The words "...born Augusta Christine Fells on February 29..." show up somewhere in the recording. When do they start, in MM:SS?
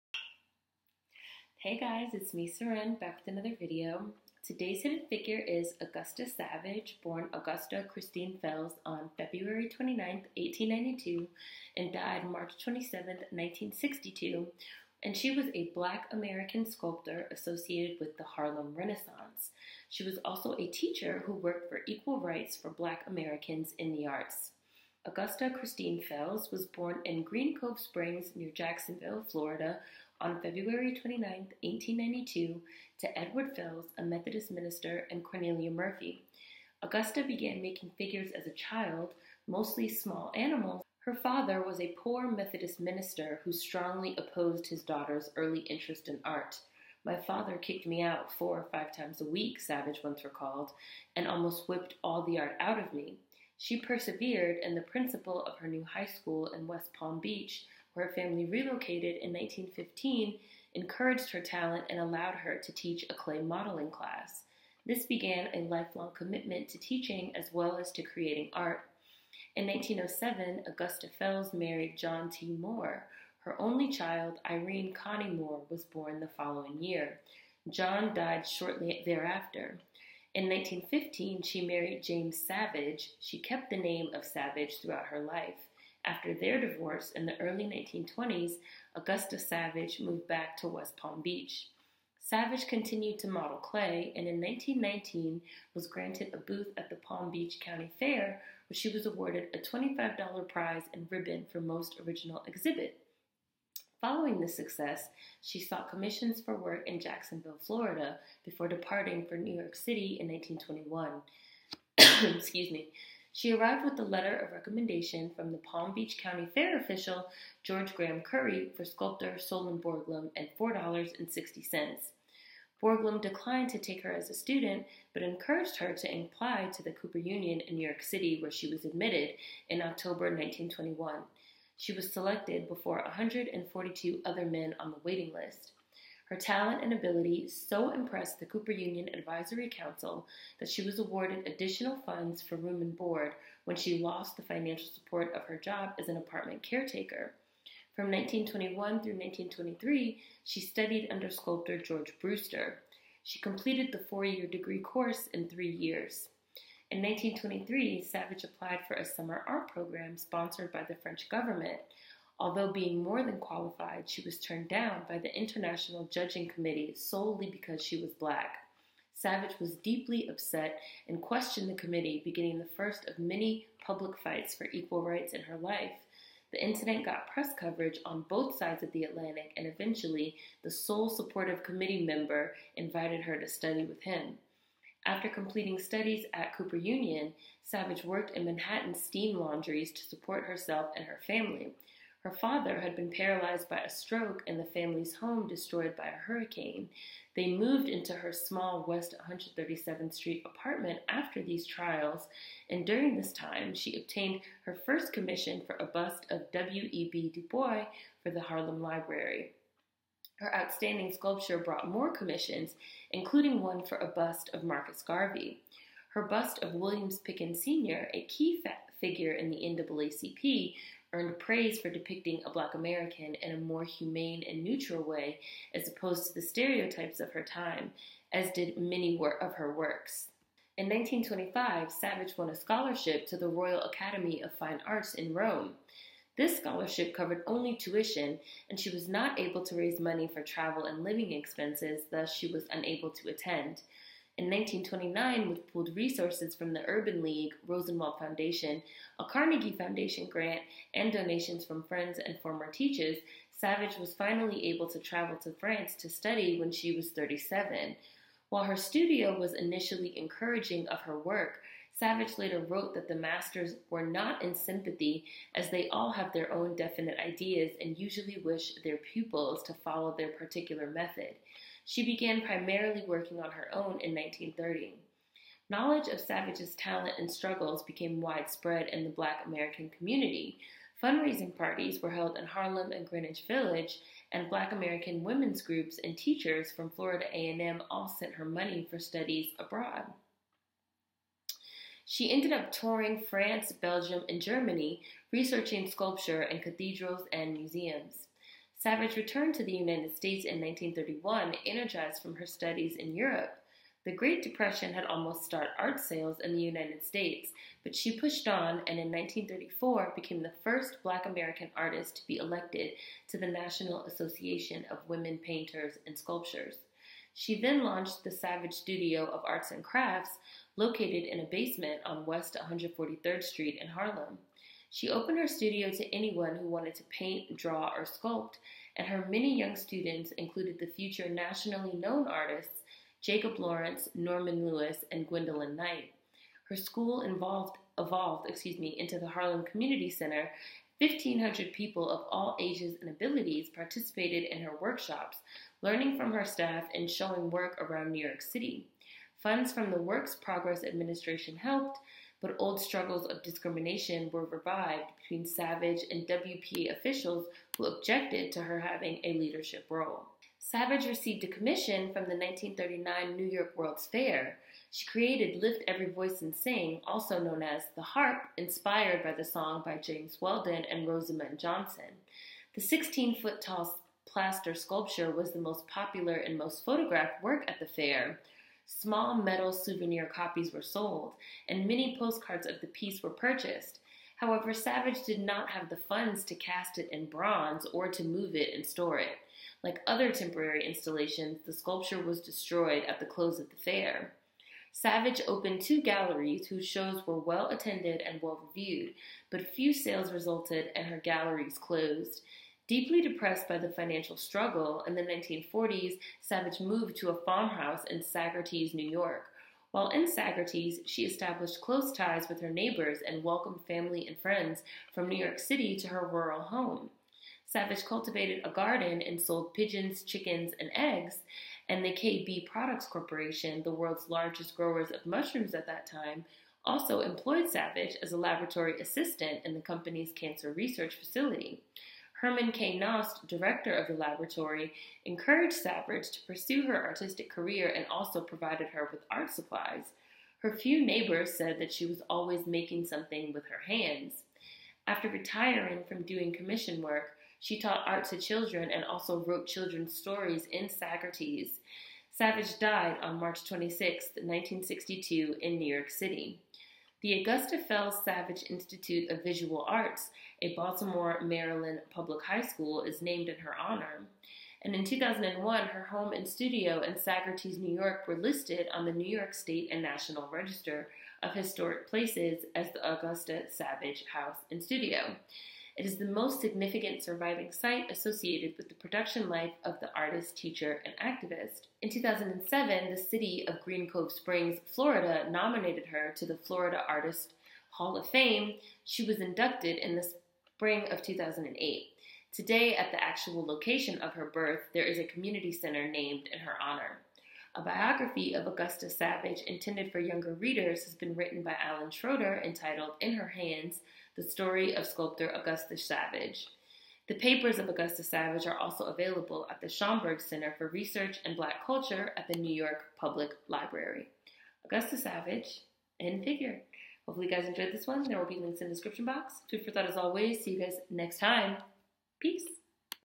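00:07.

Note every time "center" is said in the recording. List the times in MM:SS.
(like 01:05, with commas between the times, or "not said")
05:40, 08:15, 08:30.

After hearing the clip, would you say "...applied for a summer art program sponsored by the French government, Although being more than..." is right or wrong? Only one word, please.
right.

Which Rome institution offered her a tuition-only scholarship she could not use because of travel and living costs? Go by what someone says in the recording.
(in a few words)
Royal Academy of Fine Arts.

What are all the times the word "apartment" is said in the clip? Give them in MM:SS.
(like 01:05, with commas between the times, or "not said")
02:26, 03:20.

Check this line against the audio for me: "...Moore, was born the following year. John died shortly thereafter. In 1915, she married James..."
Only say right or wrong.
right.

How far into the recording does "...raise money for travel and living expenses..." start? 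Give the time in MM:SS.
03:59.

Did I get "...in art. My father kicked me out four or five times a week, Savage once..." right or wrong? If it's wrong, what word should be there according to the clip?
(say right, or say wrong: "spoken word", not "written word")
right.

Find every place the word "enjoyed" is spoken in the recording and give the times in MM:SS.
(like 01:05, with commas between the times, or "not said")
08:37.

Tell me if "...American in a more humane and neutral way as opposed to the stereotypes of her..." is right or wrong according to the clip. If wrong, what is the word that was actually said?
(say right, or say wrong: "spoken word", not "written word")
right.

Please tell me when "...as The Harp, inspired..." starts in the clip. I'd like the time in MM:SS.
06:07.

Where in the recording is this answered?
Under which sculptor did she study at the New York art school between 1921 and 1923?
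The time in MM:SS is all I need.
02:31.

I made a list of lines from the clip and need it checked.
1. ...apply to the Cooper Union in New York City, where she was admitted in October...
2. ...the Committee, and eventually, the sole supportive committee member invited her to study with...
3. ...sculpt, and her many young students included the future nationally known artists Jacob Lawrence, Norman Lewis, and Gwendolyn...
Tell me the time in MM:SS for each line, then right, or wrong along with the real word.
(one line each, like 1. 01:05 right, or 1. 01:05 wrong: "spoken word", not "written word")
1. 02:06 right
2. 02:58 wrong: "Atlantic", not "Committee"
3. 05:28 right.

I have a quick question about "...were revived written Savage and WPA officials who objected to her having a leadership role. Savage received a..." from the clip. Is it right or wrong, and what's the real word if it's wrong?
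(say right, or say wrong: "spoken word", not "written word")
wrong: "between", not "written".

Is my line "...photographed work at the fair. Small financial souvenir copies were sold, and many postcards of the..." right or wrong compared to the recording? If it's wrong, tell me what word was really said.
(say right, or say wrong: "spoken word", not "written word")
wrong: "metal", not "financial".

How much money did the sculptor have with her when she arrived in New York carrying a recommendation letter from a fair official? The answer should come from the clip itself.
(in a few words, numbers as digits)
$4.60.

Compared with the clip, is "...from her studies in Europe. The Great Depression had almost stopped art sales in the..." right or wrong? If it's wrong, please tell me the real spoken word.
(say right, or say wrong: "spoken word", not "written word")
right.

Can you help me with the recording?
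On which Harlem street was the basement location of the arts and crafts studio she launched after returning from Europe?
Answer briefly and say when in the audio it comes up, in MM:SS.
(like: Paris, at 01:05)
West 143rd Street, at 05:22.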